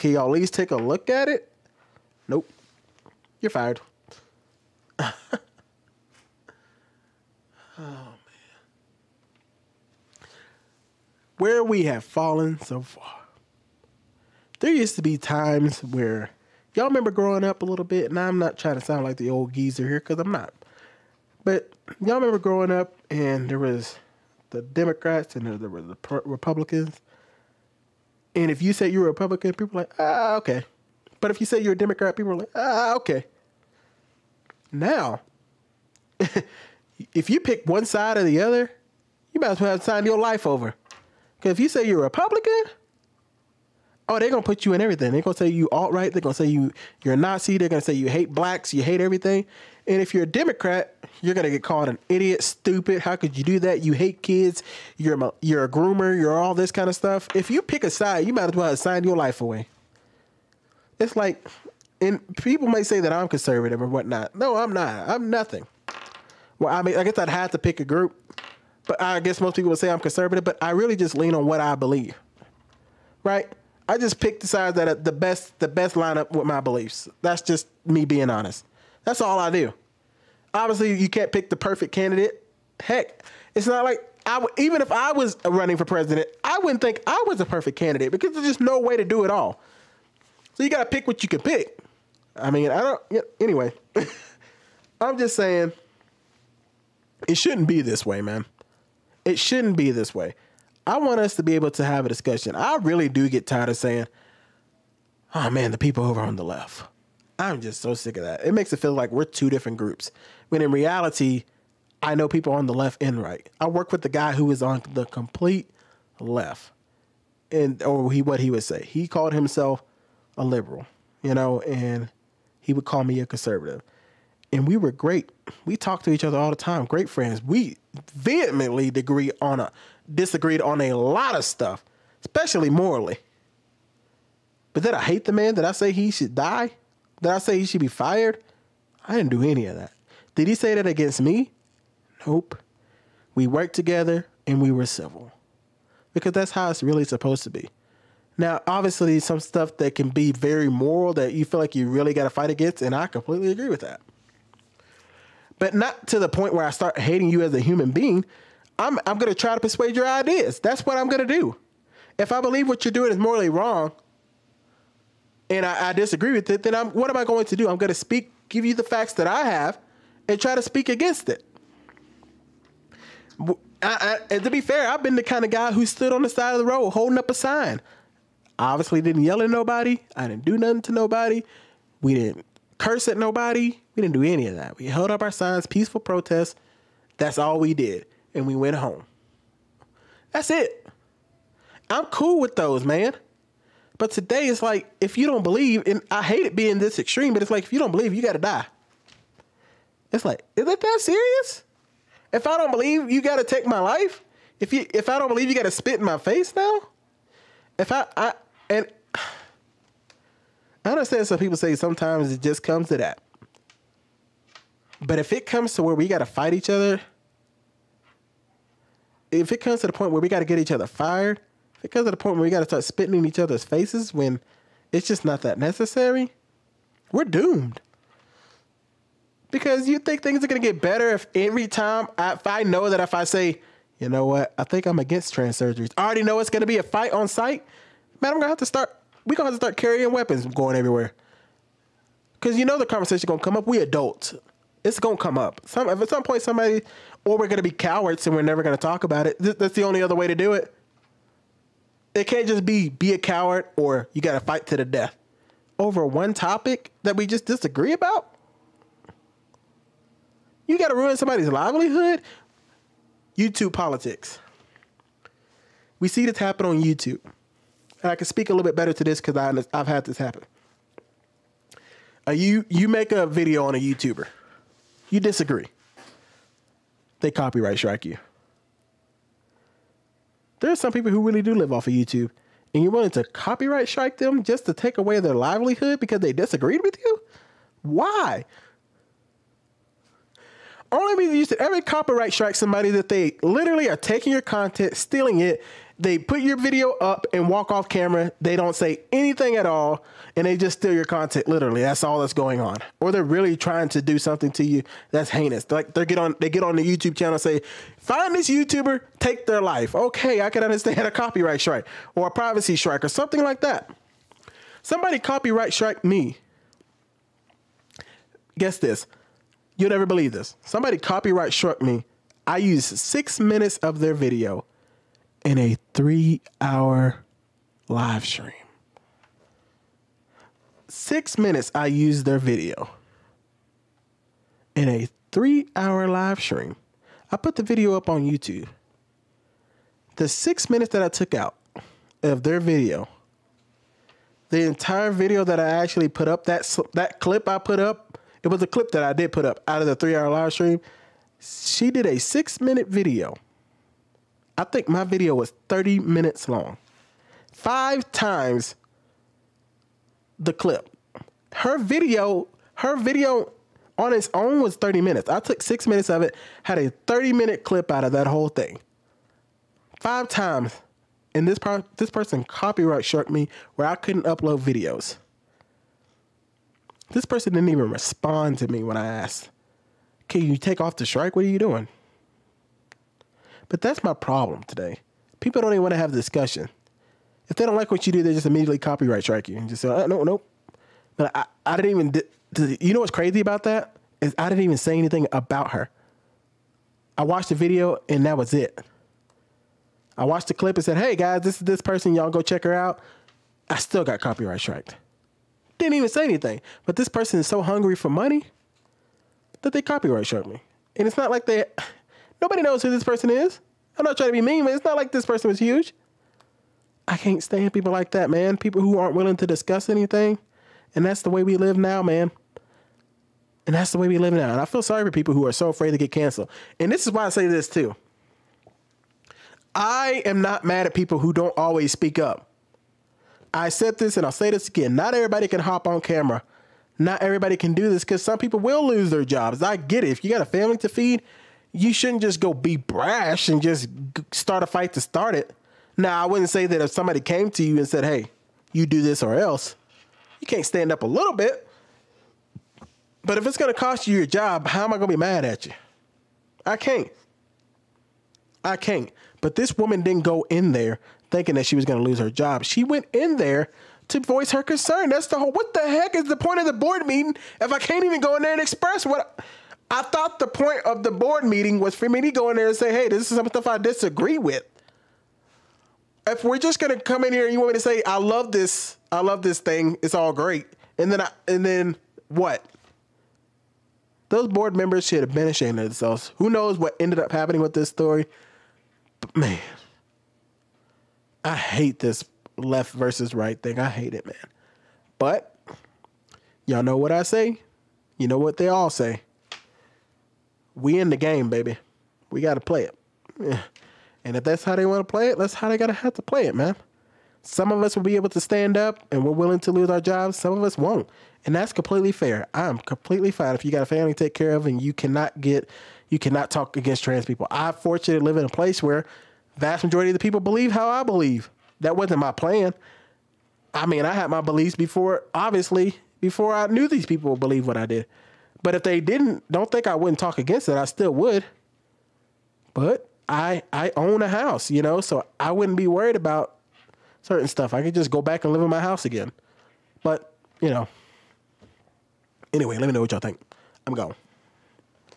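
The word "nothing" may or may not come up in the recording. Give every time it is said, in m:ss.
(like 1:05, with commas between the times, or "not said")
1:05, 3:00.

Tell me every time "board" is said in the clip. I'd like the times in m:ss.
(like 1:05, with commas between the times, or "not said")
7:46, 7:51, 8:04.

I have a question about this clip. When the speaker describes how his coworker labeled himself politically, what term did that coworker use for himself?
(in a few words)
liberal.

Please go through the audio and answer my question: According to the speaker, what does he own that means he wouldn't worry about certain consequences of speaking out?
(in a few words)
a house.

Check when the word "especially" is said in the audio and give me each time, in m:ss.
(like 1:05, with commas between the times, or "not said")
2:12.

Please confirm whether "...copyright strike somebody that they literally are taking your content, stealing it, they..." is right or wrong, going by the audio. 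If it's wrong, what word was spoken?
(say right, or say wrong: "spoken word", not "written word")
right.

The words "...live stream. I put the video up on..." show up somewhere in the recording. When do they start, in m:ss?
5:36.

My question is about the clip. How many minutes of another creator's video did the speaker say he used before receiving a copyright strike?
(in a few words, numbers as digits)
6.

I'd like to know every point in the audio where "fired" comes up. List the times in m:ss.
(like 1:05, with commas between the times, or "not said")
0:03, 2:17, 3:40.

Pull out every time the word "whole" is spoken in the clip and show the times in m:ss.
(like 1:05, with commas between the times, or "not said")
6:08, 7:45.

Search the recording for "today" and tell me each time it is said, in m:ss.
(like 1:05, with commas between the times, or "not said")
3:14, 6:24.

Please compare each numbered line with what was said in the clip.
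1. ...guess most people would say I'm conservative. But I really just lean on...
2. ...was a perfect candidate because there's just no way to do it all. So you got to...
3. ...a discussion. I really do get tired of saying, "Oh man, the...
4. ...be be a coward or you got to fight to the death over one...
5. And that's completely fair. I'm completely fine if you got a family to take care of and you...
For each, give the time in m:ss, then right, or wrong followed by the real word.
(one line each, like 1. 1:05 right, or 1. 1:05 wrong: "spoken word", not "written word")
1. 1:09 right
2. 1:27 right
3. 1:42 right
4. 4:12 right
5. 8:31 right.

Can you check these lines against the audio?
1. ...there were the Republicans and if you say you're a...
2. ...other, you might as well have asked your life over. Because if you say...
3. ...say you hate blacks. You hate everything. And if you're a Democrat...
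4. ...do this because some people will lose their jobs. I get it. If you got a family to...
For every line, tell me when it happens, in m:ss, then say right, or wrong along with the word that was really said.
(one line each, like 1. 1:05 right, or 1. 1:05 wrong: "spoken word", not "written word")
1. 0:25 right
2. 0:38 wrong: "signed", not "asked"
3. 0:47 right
4. 7:17 right.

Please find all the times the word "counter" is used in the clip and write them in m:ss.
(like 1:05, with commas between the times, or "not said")
not said.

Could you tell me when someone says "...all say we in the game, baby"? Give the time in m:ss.
8:18.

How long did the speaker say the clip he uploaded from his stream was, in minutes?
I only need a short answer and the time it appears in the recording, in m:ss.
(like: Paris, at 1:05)
30, at 5:54.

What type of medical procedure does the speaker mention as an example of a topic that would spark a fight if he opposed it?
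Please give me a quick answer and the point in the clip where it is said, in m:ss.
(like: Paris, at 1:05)
trans surgeries, at 3:55.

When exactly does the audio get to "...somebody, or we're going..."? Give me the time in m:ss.
4:06.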